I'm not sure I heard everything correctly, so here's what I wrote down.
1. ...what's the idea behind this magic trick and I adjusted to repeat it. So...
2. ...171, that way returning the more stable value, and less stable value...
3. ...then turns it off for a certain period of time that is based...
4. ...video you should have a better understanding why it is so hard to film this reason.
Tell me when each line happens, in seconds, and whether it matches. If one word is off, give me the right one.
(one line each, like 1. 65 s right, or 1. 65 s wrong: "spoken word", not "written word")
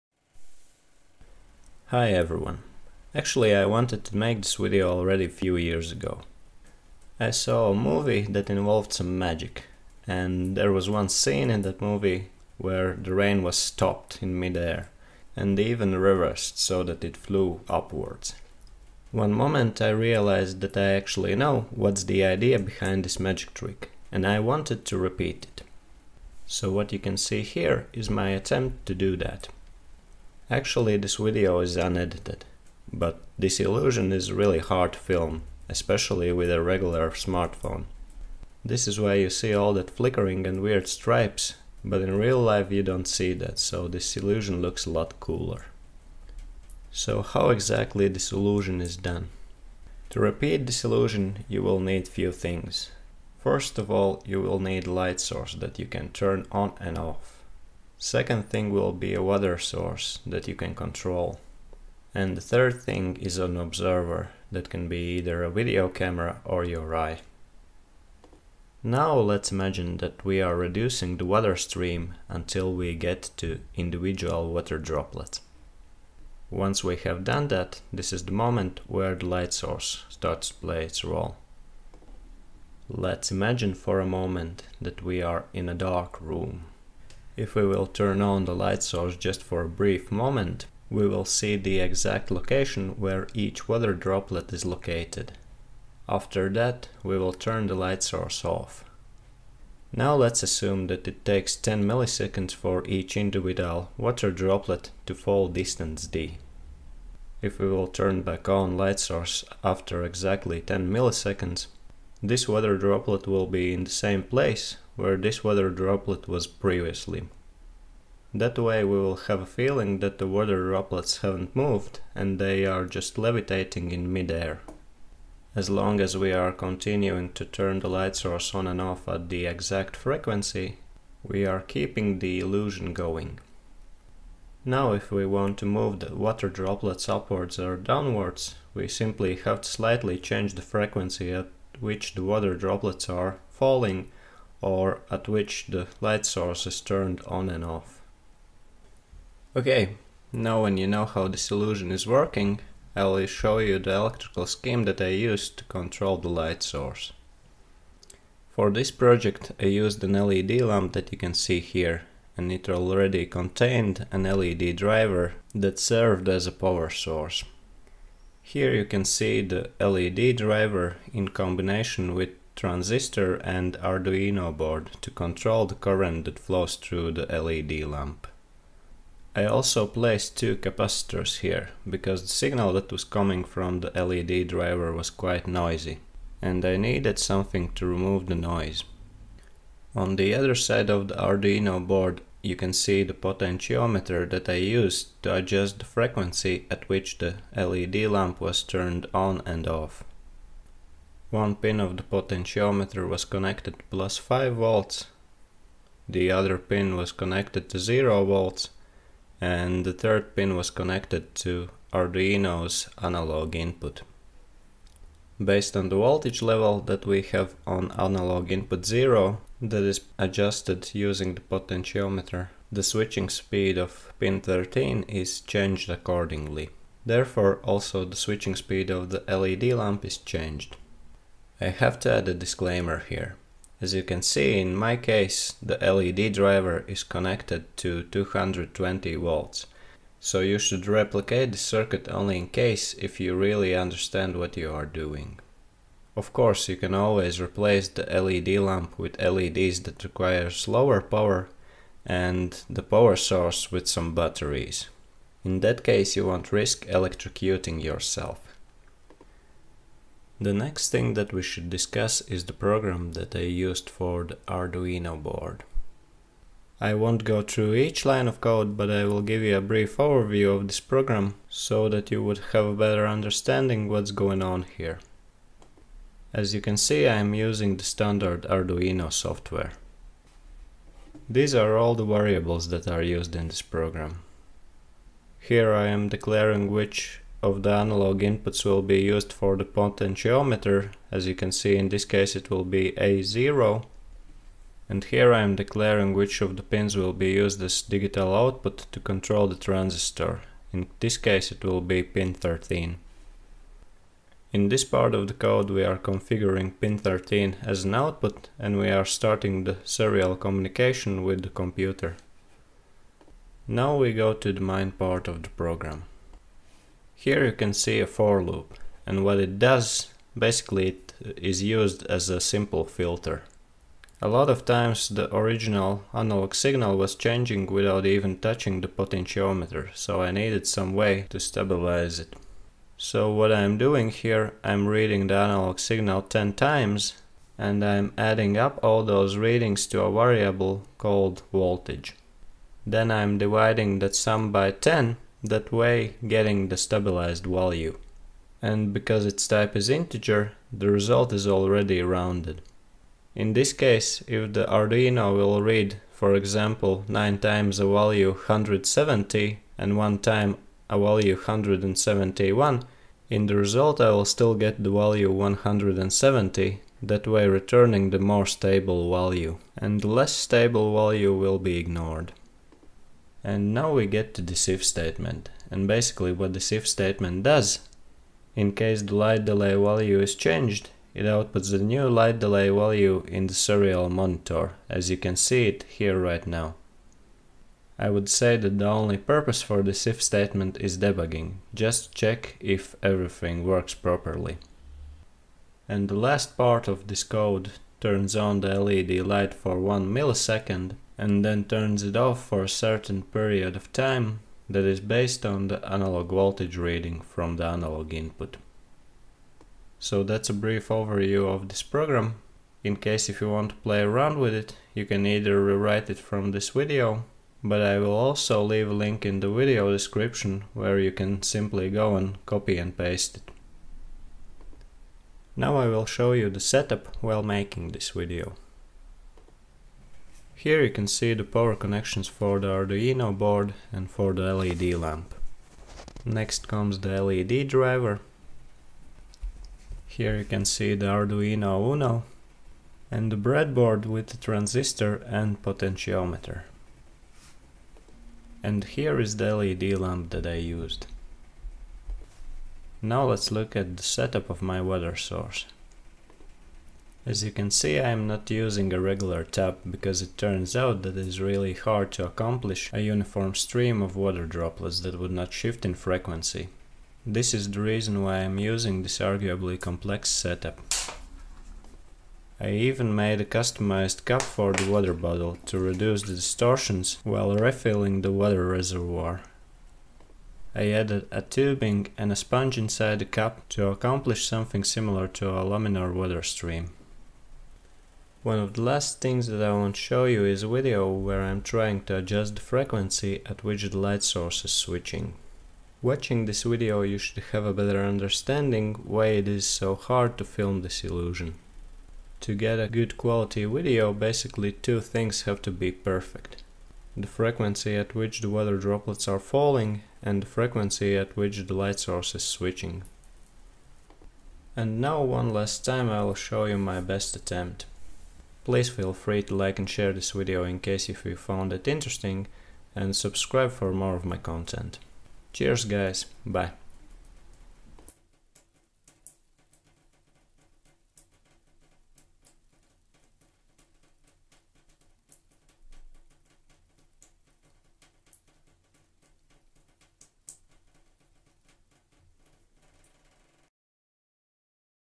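1. 21 s wrong: "wanted", not "adjusted"
2. 365 s wrong: "170", not "171"
3. 401 s right
4. 496 s wrong: "illusion", not "reason".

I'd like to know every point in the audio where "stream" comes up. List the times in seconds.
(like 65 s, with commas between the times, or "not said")
71 s, 463 s, 486 s.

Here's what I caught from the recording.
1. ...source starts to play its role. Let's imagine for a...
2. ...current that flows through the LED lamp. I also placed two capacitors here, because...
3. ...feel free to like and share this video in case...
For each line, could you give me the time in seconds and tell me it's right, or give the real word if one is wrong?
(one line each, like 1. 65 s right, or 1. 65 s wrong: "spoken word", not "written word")
1. 79 s right
2. 175 s right
3. 518 s right.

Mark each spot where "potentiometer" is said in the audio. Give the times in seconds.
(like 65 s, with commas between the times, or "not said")
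193 s, 202 s, 221 s, 289 s, 328 s, 445 s.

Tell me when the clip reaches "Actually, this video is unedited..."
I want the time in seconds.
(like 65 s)
30 s.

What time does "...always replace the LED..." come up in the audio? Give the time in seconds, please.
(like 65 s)
246 s.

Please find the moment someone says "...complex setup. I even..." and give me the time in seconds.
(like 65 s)
469 s.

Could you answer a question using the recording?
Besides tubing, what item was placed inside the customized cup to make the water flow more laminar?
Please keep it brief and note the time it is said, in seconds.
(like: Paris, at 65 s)
A sponge, at 482 s.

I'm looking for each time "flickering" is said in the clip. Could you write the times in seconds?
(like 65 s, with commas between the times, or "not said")
39 s.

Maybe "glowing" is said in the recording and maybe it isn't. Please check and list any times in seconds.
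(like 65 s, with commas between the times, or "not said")
not said.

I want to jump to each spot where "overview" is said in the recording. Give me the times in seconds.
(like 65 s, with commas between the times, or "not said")
269 s, 410 s.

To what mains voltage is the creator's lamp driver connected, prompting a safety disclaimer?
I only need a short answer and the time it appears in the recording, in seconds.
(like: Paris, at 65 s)
220 volts, at 238 s.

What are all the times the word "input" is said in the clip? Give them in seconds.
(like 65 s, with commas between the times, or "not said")
213 s, 218 s, 288 s, 408 s.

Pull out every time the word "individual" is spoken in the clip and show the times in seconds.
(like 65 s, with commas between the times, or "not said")
73 s, 103 s.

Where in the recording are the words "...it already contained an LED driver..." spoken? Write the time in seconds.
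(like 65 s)
162 s.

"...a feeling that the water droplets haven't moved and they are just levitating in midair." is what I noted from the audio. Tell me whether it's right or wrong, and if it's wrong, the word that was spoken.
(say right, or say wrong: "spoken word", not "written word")
right.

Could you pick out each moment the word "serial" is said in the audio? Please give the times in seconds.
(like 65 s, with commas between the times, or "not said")
309 s, 383 s.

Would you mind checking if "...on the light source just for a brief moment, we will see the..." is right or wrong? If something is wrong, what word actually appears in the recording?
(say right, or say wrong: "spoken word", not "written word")
right.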